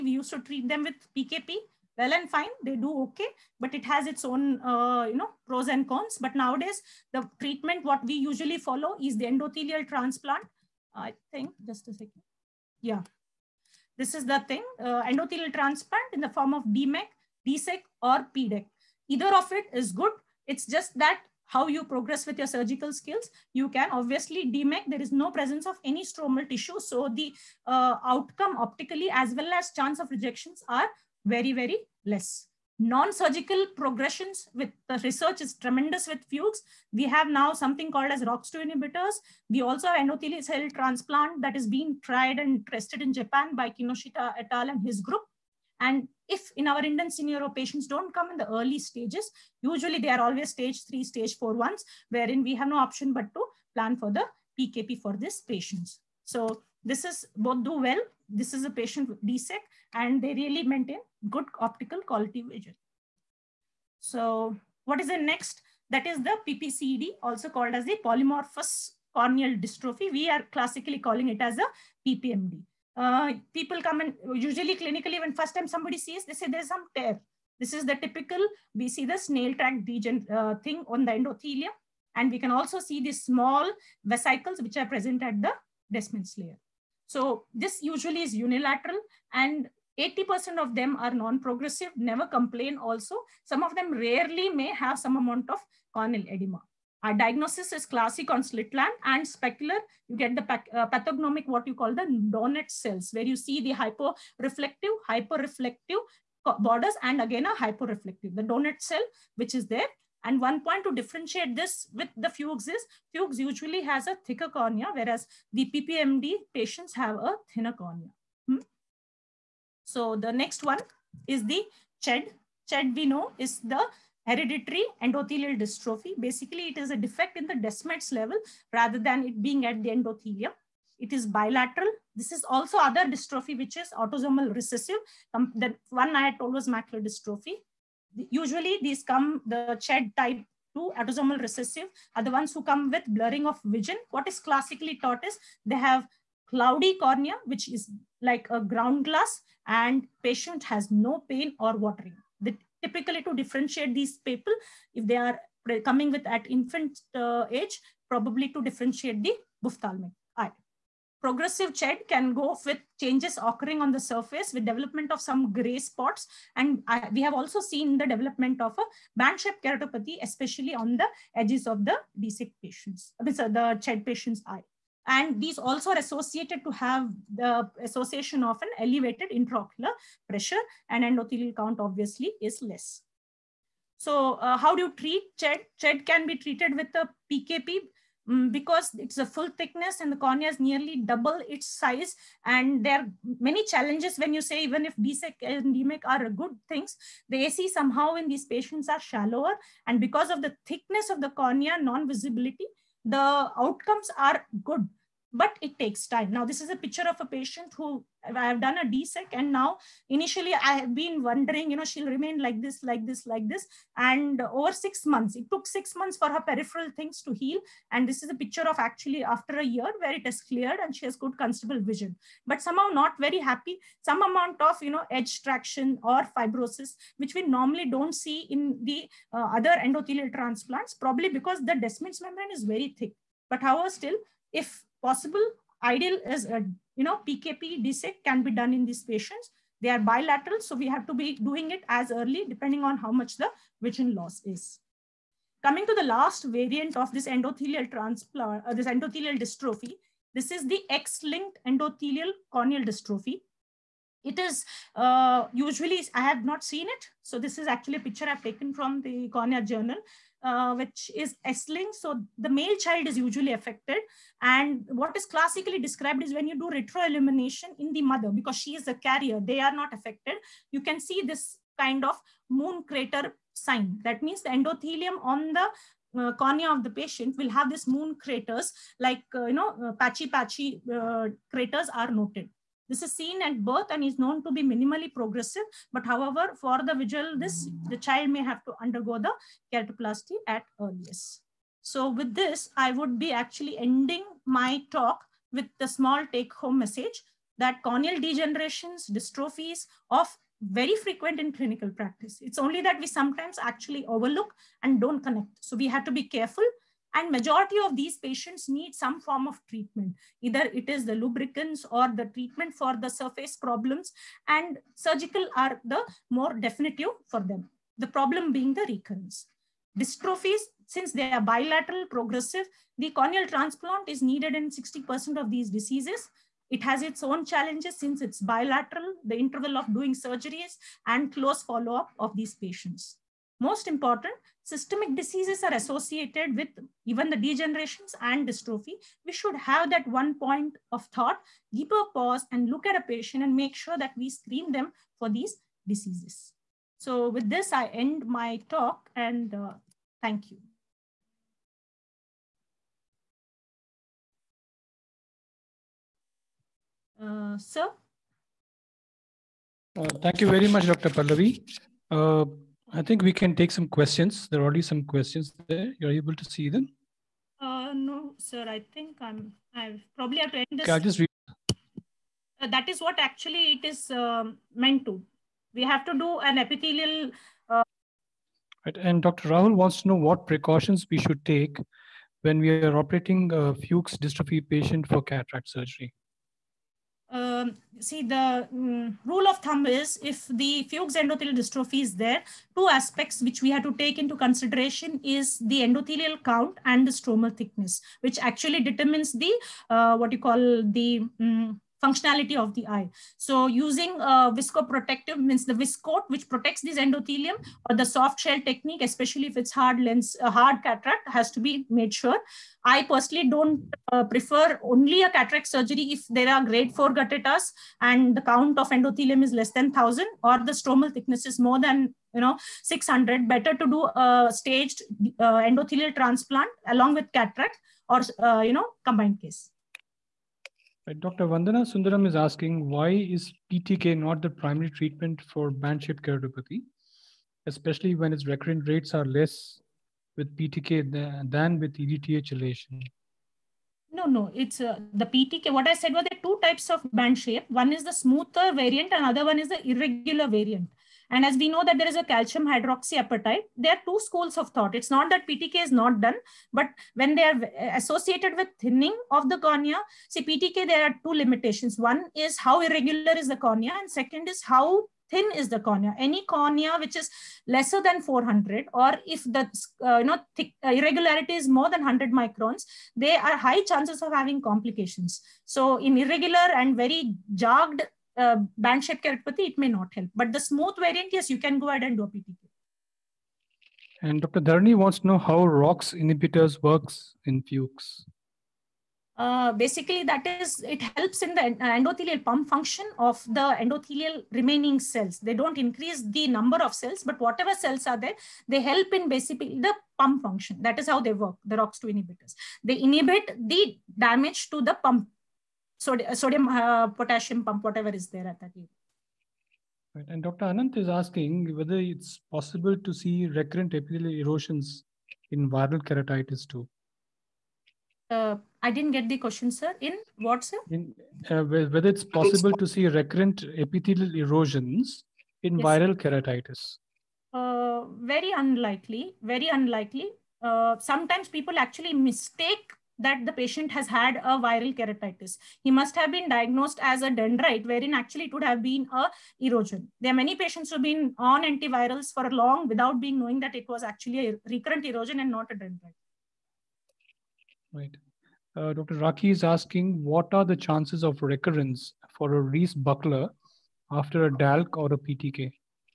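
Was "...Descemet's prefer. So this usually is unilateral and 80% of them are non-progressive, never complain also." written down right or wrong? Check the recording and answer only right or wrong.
wrong.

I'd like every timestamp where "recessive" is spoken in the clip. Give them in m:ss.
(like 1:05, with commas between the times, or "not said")
2:14, 2:21.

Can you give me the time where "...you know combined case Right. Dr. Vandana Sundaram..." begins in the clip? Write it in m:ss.
7:08.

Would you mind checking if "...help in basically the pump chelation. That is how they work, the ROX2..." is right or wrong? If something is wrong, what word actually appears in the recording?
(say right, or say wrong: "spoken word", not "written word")
wrong: "function", not "chelation".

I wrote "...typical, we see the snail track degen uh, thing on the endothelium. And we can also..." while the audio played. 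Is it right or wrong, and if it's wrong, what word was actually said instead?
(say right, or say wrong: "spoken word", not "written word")
right.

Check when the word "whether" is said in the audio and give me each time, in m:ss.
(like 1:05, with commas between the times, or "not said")
8:31, 8:41.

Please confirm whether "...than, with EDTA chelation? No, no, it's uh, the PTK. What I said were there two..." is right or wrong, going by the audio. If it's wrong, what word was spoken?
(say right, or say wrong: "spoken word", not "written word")
right.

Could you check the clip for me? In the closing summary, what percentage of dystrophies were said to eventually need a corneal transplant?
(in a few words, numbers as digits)
60%.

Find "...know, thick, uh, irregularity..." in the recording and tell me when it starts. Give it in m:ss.
7:50.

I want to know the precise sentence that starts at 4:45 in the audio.
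But however, for the visual, this the child may have to undergo the keratoplasty at earliest.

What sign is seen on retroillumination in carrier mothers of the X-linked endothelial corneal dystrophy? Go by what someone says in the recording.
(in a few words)
Moon crater sign.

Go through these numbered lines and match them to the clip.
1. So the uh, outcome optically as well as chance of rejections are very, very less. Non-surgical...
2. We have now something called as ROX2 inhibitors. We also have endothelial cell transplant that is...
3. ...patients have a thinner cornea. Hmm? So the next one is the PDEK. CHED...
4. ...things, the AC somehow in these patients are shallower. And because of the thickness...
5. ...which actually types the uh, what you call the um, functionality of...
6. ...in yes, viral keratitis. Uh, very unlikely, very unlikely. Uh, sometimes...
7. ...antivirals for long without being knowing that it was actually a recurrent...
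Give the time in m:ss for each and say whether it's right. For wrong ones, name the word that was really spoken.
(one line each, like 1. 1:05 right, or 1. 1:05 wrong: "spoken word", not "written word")
1. 0:26 right
2. 0:36 right
3. 1:56 wrong: "CHED", not "PDEK"
4. 3:16 right
5. 6:38 wrong: "determines", not "types"
6. 8:45 right
7. 9:01 right.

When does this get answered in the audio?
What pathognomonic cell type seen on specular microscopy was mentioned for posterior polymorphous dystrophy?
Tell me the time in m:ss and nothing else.
1:42.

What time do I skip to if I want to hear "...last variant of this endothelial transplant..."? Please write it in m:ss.
4:06.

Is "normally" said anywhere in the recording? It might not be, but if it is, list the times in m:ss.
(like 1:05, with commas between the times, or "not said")
3:47.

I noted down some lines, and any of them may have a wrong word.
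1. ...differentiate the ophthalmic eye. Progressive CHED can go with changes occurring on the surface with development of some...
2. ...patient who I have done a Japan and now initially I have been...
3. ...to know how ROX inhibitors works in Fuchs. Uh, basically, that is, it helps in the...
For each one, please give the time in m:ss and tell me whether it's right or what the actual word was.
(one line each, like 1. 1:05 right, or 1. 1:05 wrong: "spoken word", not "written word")
1. 2:38 right
2. 3:27 wrong: "DSEK", not "Japan"
3. 8:05 right.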